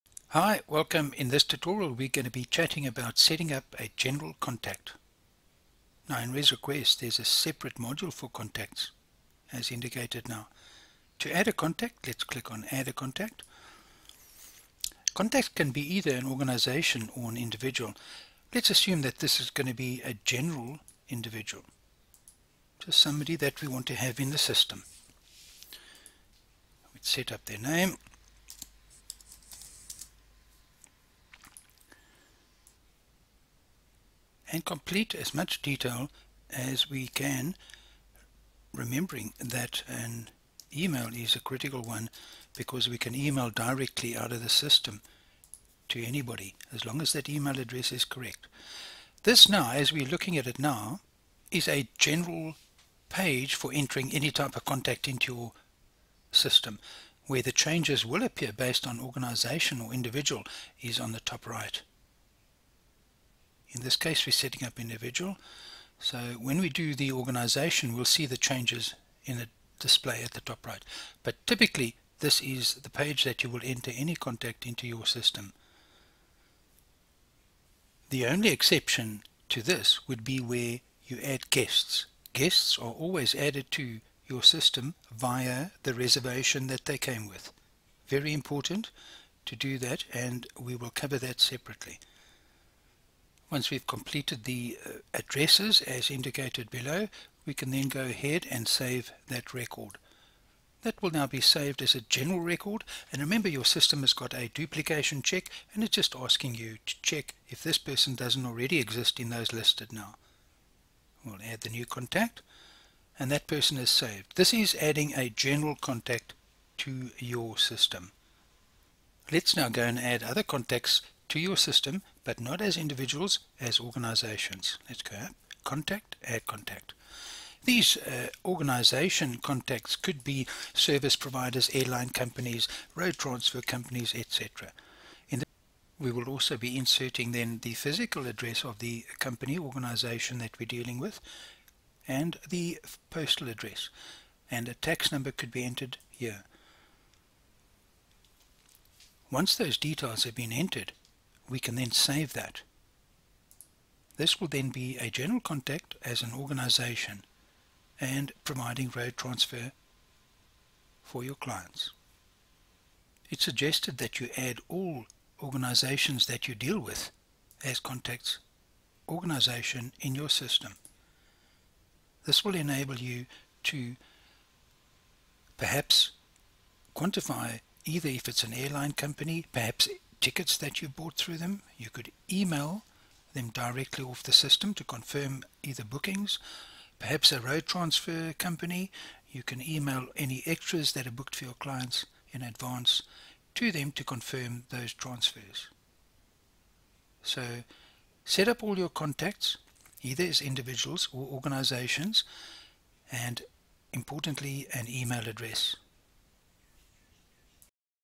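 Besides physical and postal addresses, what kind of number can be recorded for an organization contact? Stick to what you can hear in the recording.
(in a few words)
Tax number.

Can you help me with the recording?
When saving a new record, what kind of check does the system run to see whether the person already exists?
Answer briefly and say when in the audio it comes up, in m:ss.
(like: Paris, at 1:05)
Duplication check, at 1:44.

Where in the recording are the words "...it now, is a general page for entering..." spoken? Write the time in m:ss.
0:50.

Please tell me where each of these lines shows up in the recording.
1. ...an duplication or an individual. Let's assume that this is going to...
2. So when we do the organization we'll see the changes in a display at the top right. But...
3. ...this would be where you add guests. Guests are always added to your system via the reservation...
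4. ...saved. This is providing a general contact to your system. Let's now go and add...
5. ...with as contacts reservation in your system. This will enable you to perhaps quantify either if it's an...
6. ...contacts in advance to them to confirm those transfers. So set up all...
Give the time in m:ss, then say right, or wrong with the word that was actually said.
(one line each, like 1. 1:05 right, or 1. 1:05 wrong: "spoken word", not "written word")
1. 0:16 wrong: "organization", not "duplication"
2. 1:05 right
3. 1:19 right
4. 1:53 wrong: "adding", not "providing"
5. 2:46 wrong: "organization", not "reservation"
6. 3:11 wrong: "clients", not "contacts".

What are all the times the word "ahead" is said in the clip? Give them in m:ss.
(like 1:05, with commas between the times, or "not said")
1:38.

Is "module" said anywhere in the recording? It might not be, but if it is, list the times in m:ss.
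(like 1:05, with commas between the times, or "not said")
0:07.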